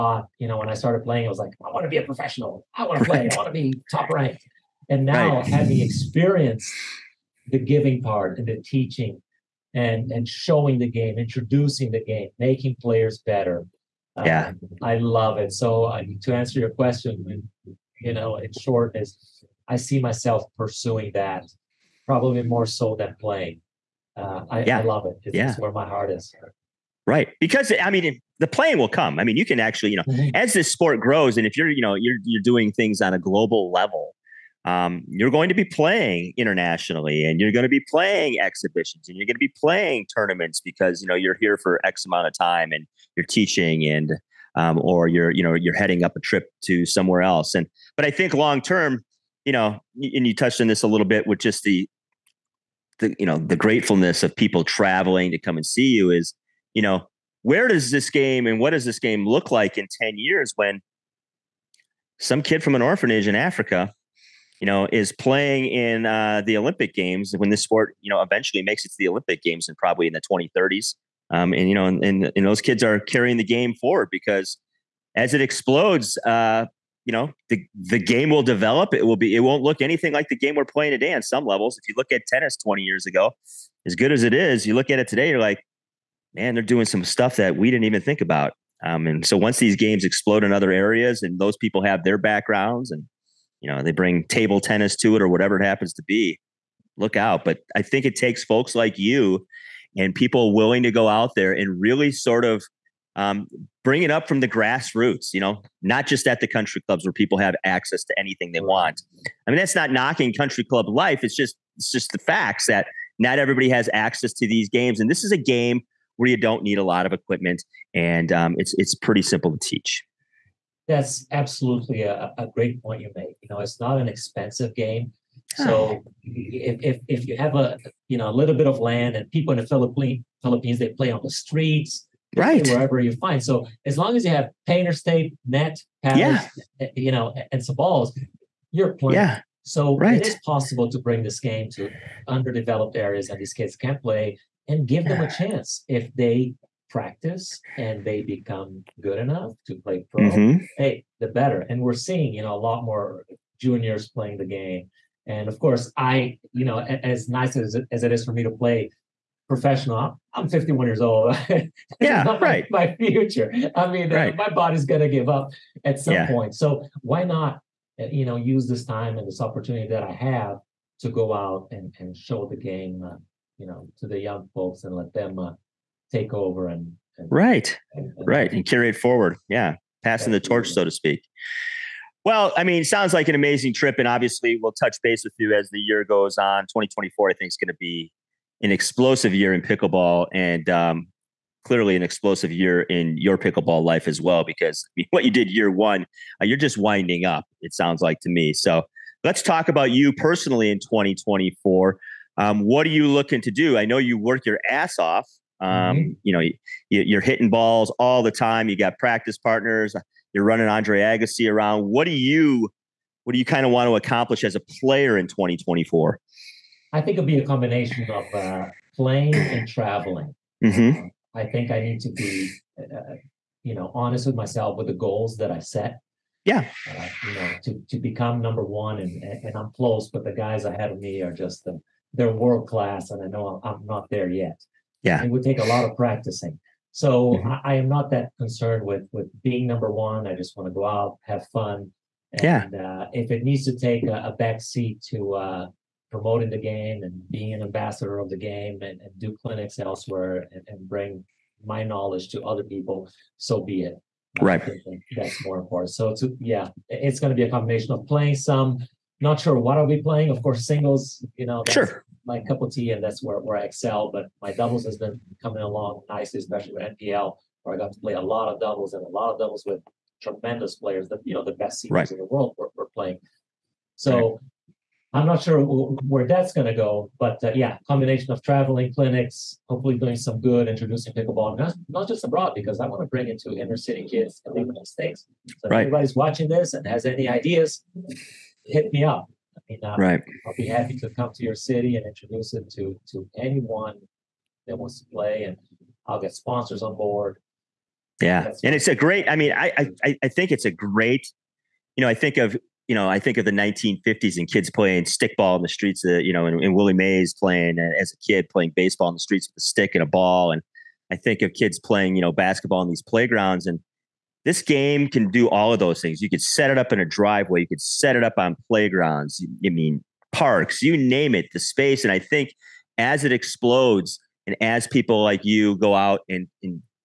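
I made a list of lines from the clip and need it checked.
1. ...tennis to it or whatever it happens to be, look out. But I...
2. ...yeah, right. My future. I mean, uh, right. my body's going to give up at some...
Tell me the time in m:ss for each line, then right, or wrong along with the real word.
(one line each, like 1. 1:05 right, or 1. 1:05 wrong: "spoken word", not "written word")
1. 1:34 right
2. 2:42 right.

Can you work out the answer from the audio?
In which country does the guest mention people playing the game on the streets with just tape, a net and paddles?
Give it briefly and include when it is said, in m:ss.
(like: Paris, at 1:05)
Philippines, at 2:10.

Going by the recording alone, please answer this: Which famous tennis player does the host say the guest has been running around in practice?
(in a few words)
Andre Agassi.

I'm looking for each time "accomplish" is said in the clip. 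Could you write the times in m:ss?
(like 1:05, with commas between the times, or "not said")
3:33.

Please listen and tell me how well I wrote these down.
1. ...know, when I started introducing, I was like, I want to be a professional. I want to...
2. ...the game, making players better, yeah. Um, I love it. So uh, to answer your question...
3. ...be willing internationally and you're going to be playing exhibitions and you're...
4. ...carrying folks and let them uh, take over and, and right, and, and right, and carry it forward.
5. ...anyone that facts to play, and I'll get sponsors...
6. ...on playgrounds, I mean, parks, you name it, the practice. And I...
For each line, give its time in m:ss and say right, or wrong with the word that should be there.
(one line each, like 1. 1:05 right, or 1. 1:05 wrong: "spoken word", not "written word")
1. 0:00 wrong: "playing", not "introducing"
2. 0:11 right
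3. 0:35 wrong: "playing", not "willing"
4. 2:54 wrong: "young", not "carrying"
5. 4:53 wrong: "wants", not "facts"
6. 5:18 wrong: "space", not "practice".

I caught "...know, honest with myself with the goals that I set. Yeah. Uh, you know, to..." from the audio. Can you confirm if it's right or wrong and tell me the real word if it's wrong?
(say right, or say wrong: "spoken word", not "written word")
right.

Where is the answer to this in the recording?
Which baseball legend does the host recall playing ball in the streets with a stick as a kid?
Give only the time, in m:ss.
5:06.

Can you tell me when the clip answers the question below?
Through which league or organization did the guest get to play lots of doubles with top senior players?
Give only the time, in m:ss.
4:26.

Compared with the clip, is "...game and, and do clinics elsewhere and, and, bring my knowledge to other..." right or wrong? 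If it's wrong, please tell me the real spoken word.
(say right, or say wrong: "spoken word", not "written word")
right.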